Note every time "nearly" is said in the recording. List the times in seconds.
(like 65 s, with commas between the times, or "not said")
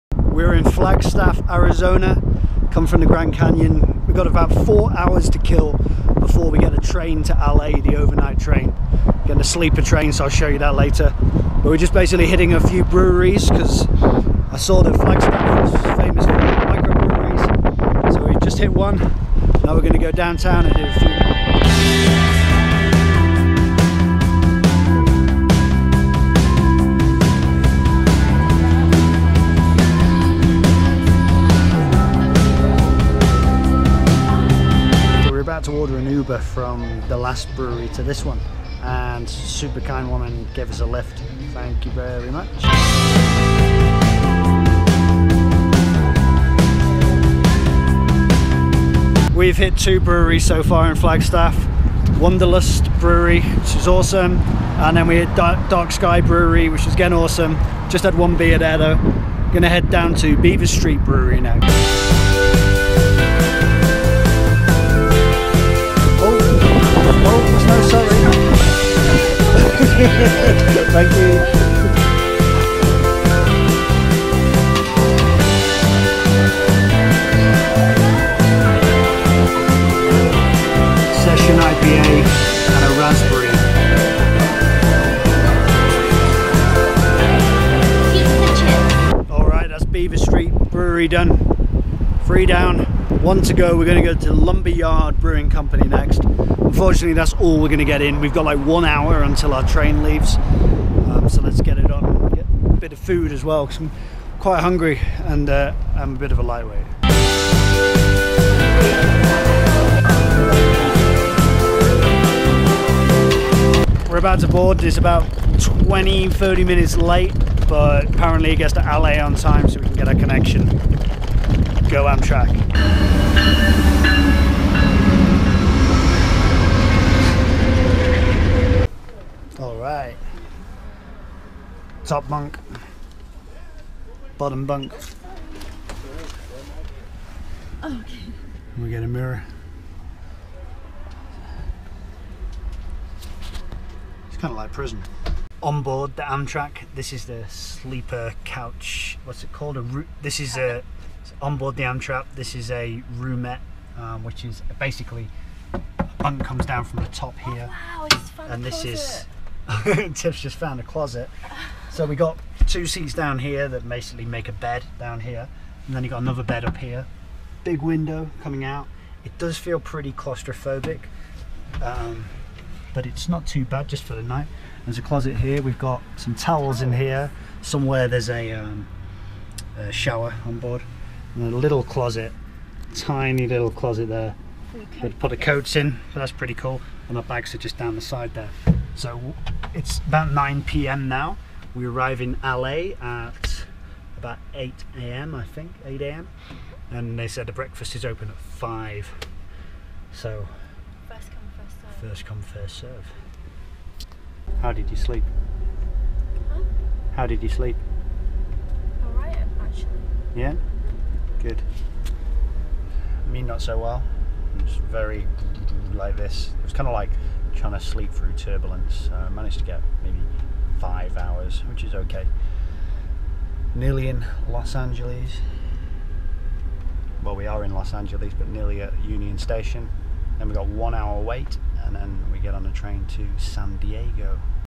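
223 s, 228 s.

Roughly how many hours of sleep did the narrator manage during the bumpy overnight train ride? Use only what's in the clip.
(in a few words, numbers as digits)
5.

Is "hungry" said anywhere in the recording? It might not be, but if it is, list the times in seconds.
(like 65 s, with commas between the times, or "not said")
104 s.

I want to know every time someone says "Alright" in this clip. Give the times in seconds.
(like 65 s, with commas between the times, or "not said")
129 s, 209 s.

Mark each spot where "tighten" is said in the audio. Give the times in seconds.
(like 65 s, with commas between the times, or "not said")
not said.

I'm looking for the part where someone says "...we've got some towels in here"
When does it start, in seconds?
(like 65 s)
175 s.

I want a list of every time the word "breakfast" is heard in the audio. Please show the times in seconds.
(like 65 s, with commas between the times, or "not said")
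197 s.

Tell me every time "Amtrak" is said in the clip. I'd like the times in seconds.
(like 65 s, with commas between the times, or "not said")
122 s, 146 s, 151 s.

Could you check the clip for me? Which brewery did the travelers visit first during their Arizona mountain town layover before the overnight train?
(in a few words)
Wanderlust Brewery.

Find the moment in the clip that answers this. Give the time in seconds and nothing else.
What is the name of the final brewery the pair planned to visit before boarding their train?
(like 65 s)
94 s.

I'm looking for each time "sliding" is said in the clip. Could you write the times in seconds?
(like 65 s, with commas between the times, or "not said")
not said.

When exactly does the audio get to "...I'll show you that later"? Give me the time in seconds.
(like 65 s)
10 s.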